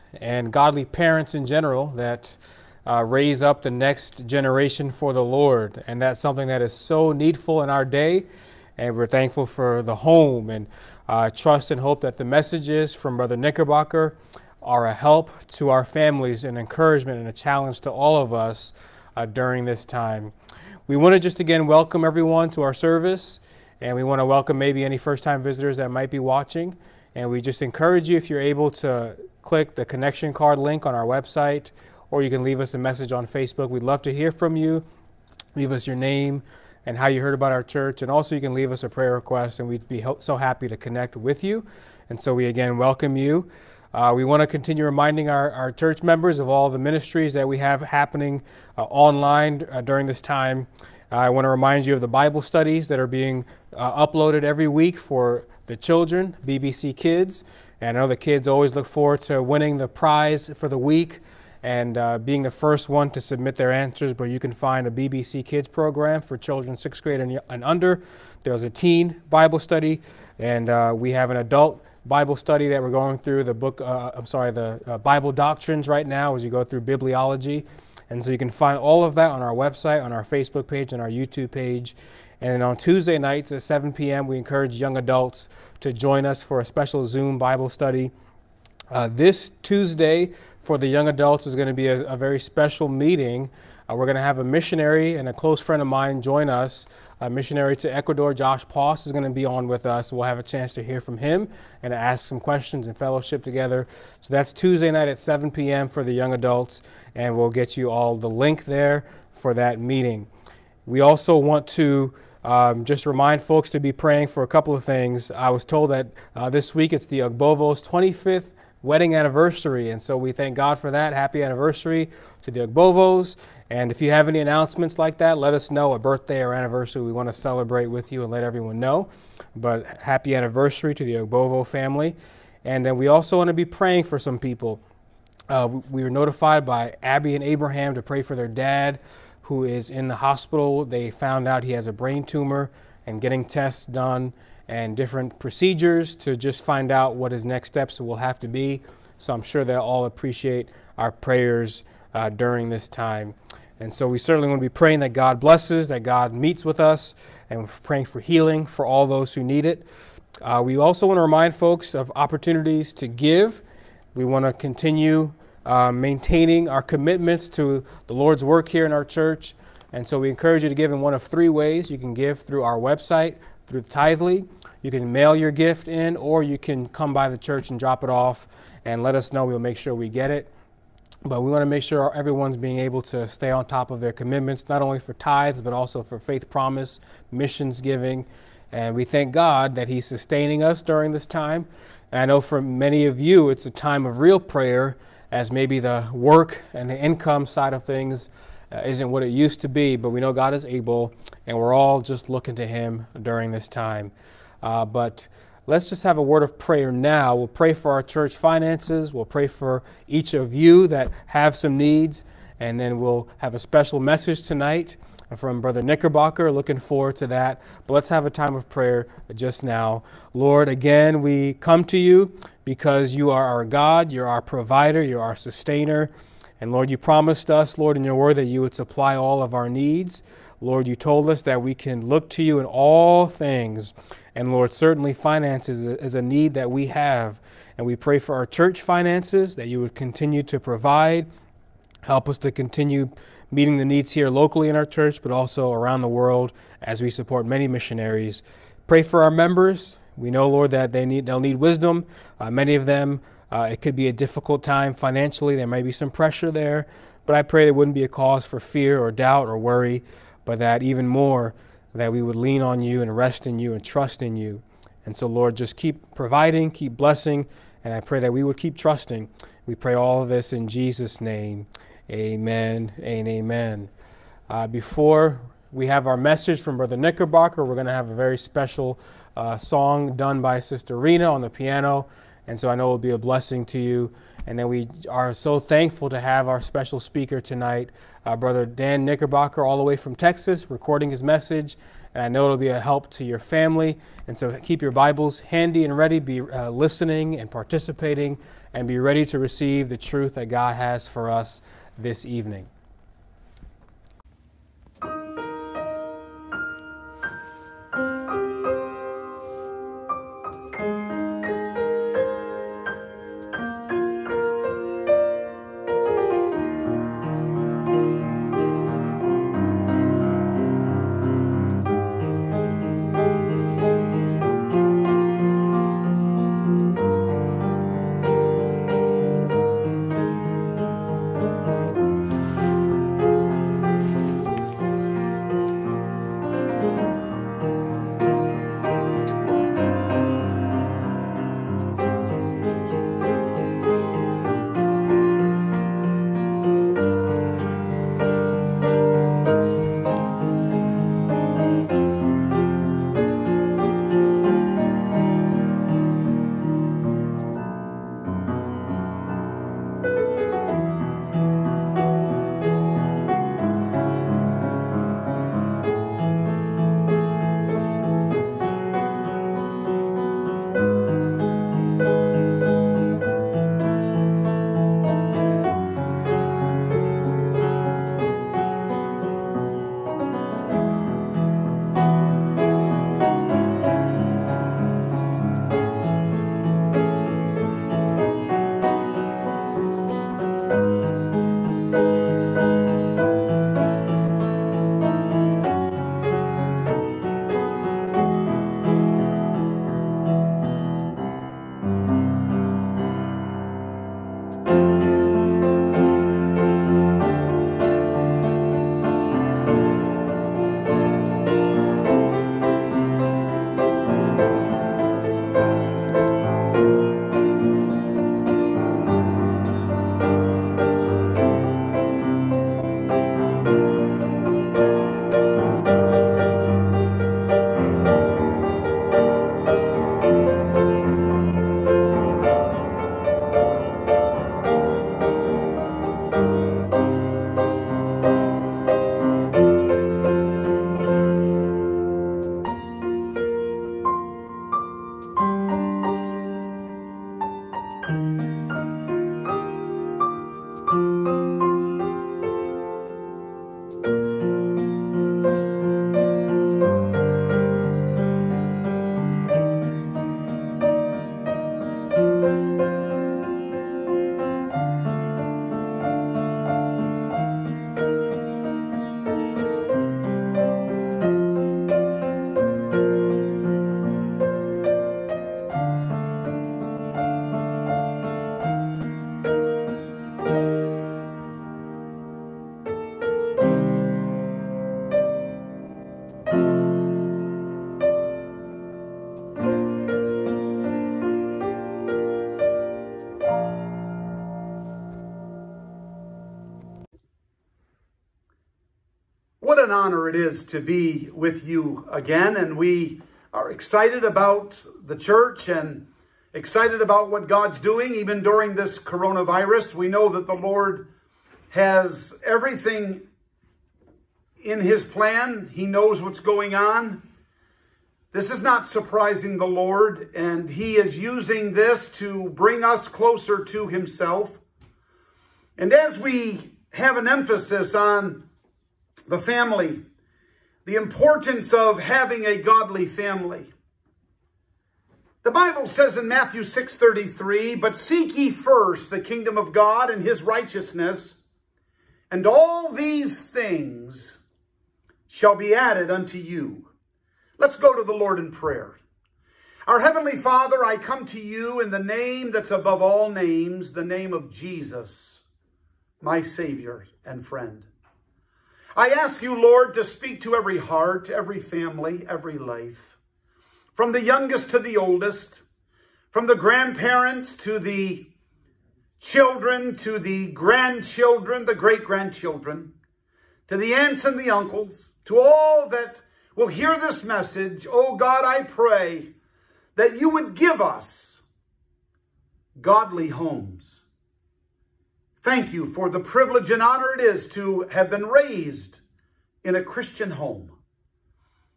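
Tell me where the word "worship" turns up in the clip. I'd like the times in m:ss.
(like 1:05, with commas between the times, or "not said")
not said.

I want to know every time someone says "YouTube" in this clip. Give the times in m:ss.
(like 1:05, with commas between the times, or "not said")
1:21.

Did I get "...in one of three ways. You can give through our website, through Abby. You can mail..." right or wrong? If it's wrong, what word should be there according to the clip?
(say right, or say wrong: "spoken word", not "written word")
wrong: "Tithely", not "Abby".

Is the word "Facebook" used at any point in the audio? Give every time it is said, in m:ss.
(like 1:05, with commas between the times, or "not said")
0:33, 1:20.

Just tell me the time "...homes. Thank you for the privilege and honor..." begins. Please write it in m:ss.
9:43.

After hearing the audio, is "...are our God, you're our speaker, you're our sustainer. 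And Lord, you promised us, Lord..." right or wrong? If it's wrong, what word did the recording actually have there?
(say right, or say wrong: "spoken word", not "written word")
wrong: "provider", not "speaker".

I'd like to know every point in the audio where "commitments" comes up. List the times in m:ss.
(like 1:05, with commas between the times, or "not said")
2:46, 3:04.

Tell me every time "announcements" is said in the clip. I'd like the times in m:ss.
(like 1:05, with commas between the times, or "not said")
2:04.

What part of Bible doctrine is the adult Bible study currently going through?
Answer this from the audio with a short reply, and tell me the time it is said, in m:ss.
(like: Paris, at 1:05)
bibliology, at 1:16.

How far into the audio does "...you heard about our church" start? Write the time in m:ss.
0:37.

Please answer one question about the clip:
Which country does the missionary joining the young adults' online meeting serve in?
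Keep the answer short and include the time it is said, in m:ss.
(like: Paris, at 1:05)
Ecuador, at 1:37.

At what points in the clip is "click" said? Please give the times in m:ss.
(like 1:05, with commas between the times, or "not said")
0:29.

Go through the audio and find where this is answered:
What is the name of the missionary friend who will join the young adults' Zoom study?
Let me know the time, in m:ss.
1:38.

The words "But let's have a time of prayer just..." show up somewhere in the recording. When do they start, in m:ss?
3:37.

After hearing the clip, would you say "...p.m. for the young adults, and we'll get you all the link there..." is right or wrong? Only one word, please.
right.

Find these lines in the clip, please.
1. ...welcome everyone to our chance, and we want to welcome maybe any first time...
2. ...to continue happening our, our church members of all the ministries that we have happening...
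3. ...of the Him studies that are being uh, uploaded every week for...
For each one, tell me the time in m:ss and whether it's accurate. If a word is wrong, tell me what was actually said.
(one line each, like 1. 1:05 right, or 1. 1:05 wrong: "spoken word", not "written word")
1. 0:21 wrong: "service", not "chance"
2. 0:44 wrong: "reminding", not "happening"
3. 0:51 wrong: "Bible", not "Him".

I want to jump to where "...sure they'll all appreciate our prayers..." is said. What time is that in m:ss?
2:29.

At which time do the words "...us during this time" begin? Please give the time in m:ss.
3:10.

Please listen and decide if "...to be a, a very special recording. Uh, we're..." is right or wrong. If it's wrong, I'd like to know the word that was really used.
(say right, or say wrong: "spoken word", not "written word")
wrong: "meeting", not "recording".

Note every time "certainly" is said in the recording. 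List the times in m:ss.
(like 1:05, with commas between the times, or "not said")
2:34, 3:54.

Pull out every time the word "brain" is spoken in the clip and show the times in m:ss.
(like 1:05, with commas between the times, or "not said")
2:21.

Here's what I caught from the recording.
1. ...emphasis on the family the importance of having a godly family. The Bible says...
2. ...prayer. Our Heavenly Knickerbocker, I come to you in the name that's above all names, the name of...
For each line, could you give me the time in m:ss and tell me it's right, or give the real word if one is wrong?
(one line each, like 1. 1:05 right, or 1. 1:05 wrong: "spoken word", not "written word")
1. 8:47 right
2. 9:08 wrong: "Father", not "Knickerbocker".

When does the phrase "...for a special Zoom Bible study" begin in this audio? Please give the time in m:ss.
1:26.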